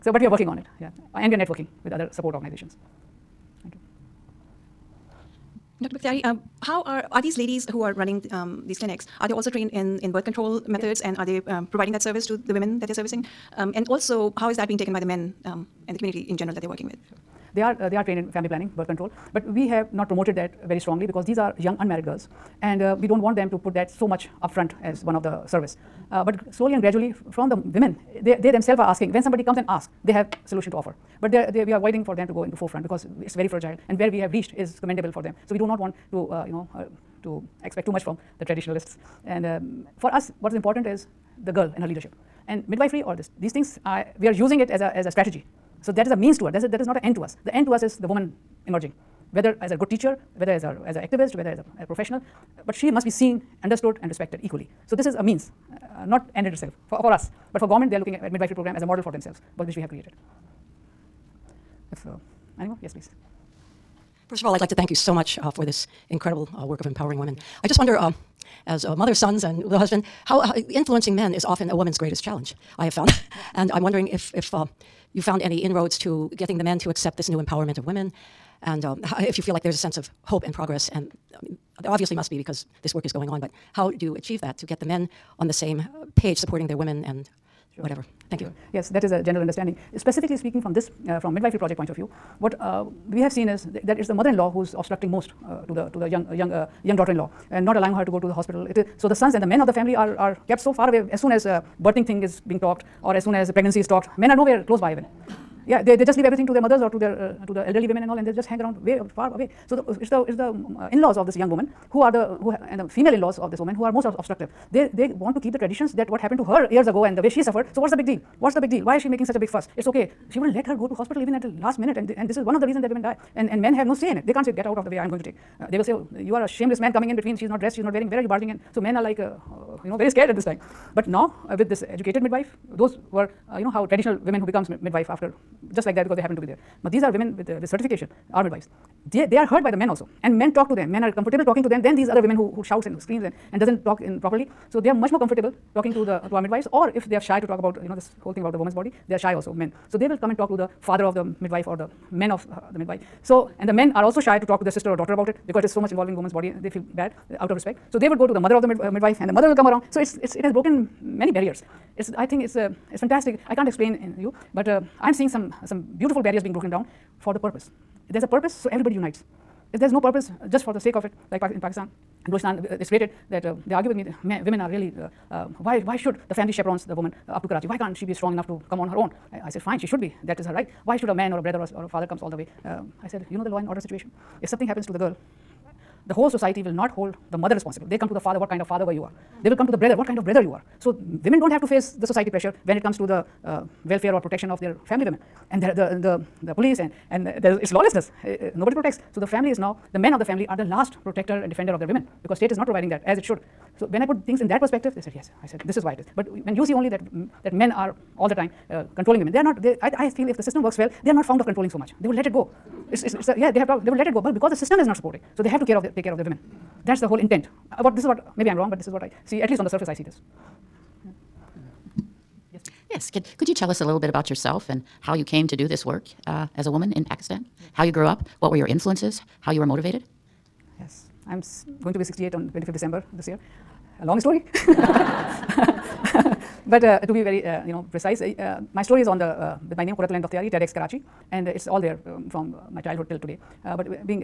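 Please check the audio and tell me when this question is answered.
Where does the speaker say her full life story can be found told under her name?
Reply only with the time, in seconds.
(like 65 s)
240 s.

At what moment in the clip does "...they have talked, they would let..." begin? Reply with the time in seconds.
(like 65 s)
213 s.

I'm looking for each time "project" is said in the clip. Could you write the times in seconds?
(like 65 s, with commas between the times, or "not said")
91 s.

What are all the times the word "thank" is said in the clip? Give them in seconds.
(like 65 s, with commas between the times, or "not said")
3 s, 64 s, 88 s.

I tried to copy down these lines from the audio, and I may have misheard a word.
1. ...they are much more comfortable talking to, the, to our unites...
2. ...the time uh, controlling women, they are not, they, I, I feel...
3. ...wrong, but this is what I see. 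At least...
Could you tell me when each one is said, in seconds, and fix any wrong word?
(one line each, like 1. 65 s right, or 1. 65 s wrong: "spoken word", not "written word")
1. 144 s wrong: "midwives", not "unites"
2. 208 s right
3. 218 s right.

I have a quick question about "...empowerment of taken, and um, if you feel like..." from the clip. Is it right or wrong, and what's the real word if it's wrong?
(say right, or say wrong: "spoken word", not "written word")
wrong: "women", not "taken".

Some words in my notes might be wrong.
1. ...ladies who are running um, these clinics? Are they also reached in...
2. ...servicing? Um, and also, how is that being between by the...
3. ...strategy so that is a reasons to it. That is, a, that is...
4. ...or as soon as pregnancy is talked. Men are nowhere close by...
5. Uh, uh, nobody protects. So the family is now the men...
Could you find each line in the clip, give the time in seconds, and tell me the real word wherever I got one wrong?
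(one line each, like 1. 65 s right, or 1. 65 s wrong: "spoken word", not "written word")
1. 7 s wrong: "trained", not "reached"
2. 12 s wrong: "taken", not "between"
3. 45 s wrong: "means", not "reasons"
4. 103 s right
5. 198 s right.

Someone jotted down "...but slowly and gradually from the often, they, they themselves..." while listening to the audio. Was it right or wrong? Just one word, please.
wrong.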